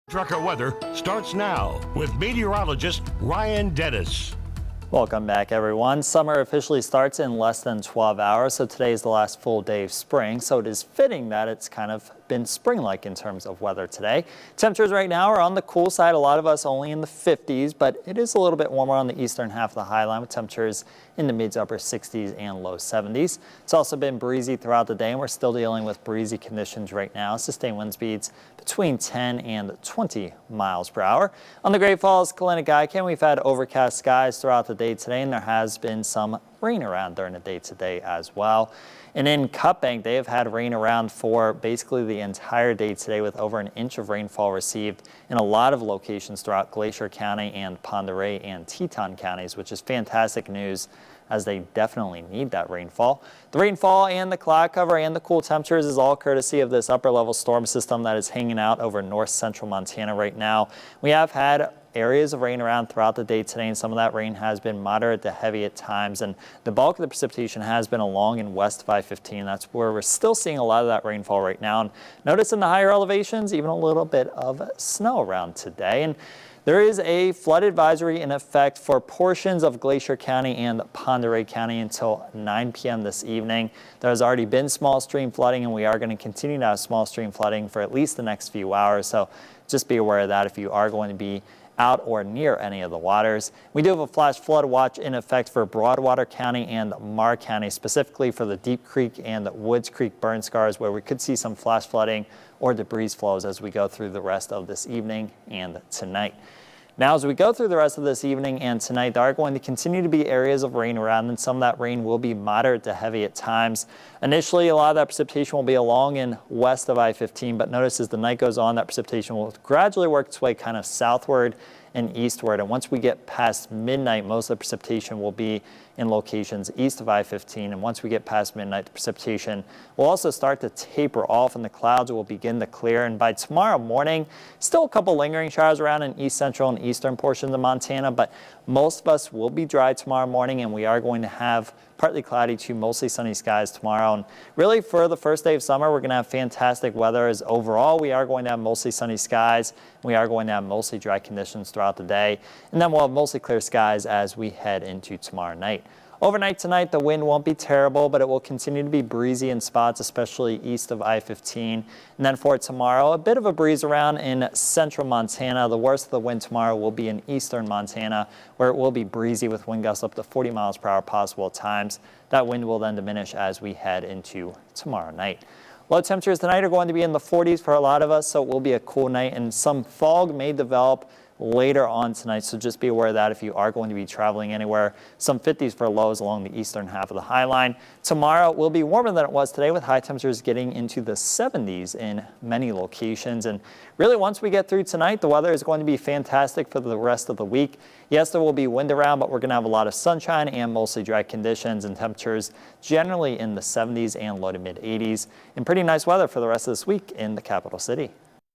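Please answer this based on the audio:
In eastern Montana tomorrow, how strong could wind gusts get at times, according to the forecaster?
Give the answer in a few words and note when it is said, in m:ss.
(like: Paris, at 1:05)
40 miles per hour, at 2:50.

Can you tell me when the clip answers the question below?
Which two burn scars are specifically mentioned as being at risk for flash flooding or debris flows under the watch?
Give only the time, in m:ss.
1:38.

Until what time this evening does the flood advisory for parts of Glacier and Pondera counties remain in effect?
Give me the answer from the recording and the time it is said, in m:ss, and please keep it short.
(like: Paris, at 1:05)
9 p.m., at 1:22.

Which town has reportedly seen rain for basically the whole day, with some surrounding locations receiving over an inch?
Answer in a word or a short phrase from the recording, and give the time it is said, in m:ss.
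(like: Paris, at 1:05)
Cut Bank, at 0:39.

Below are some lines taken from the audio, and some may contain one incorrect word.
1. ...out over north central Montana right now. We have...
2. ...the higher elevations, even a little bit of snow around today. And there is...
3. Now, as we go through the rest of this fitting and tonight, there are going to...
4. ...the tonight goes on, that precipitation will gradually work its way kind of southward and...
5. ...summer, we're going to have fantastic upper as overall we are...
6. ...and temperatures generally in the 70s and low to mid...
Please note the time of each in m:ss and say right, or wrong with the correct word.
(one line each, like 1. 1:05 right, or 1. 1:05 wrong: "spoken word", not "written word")
1. 0:58 right
2. 1:12 right
3. 1:46 wrong: "evening", not "fitting"
4. 1:58 wrong: "night", not "tonight"
5. 2:25 wrong: "weather", not "upper"
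6. 3:21 right.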